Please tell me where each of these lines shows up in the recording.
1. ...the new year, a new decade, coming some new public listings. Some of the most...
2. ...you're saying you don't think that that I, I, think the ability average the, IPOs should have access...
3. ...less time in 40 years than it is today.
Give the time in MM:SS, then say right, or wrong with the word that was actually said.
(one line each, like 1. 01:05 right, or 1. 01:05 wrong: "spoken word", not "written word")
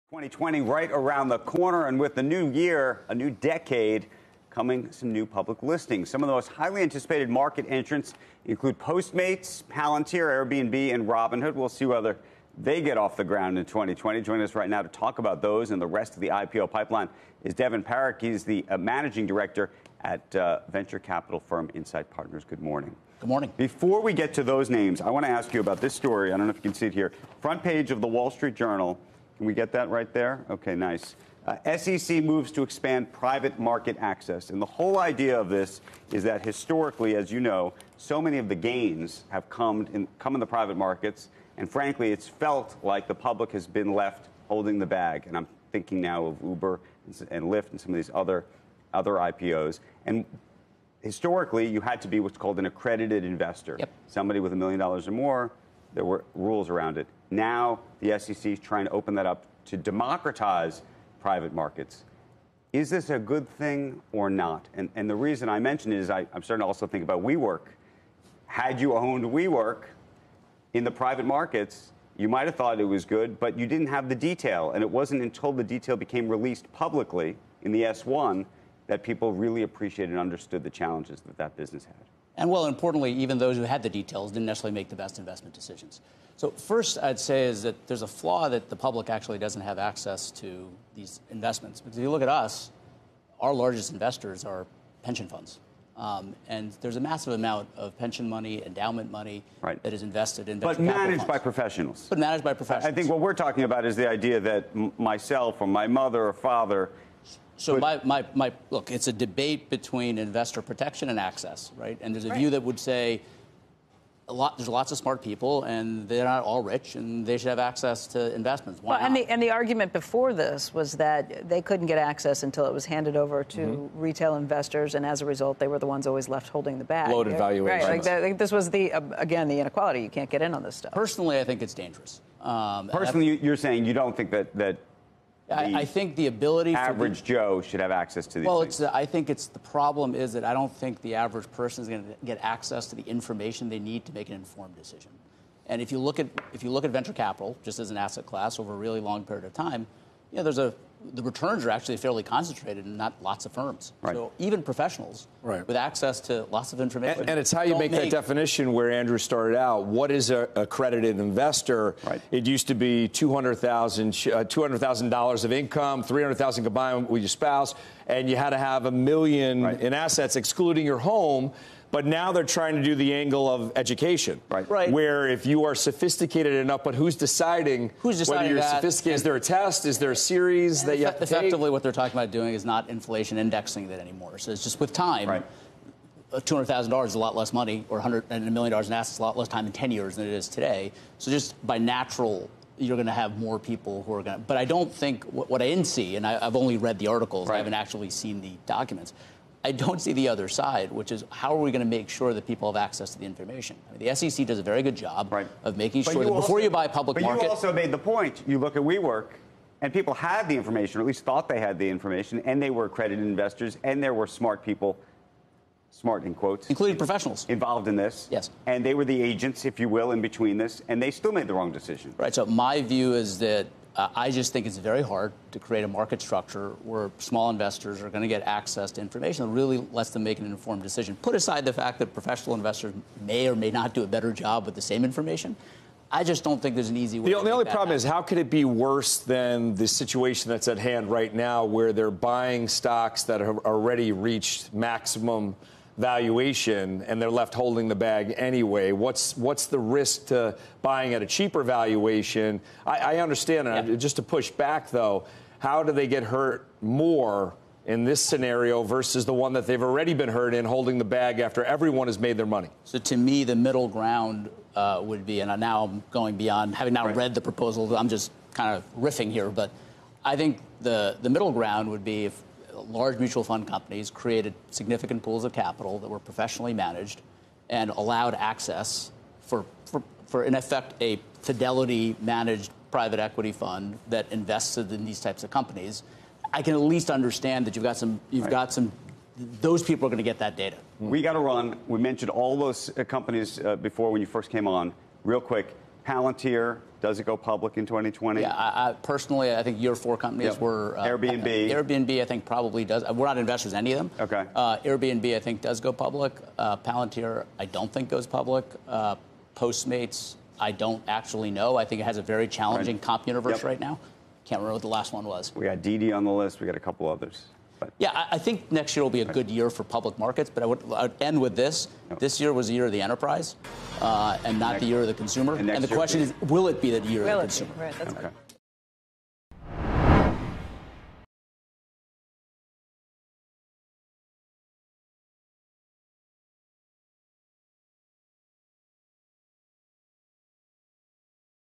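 1. 00:02 right
2. 02:13 wrong: "Joe", not "IPOs"
3. 03:09 wrong: "10", not "40".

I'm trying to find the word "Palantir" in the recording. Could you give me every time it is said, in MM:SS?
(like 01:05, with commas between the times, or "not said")
00:09, 04:56, 05:06.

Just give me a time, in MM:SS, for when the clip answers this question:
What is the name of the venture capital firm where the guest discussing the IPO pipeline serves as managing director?
00:21.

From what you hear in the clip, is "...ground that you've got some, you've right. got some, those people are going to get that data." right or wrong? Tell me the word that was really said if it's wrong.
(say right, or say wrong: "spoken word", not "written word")
wrong: "understand", not "ground".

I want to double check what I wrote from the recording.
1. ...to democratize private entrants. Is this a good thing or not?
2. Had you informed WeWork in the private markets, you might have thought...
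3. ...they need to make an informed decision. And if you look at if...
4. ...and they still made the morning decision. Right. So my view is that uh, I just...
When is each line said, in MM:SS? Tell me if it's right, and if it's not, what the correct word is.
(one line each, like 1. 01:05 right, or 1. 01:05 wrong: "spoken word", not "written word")
1. 00:59 wrong: "markets", not "entrants"
2. 01:08 wrong: "owned", not "informed"
3. 02:23 right
4. 03:40 wrong: "wrong", not "morning".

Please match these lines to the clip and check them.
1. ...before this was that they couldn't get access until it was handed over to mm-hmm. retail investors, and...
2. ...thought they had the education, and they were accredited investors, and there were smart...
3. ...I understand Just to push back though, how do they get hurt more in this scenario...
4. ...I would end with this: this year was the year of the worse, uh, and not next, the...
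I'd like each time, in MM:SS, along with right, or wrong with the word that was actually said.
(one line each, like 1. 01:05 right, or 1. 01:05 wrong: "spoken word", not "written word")
1. 01:59 right
2. 03:31 wrong: "information", not "education"
3. 04:13 right
4. 05:20 wrong: "enterprise", not "worse".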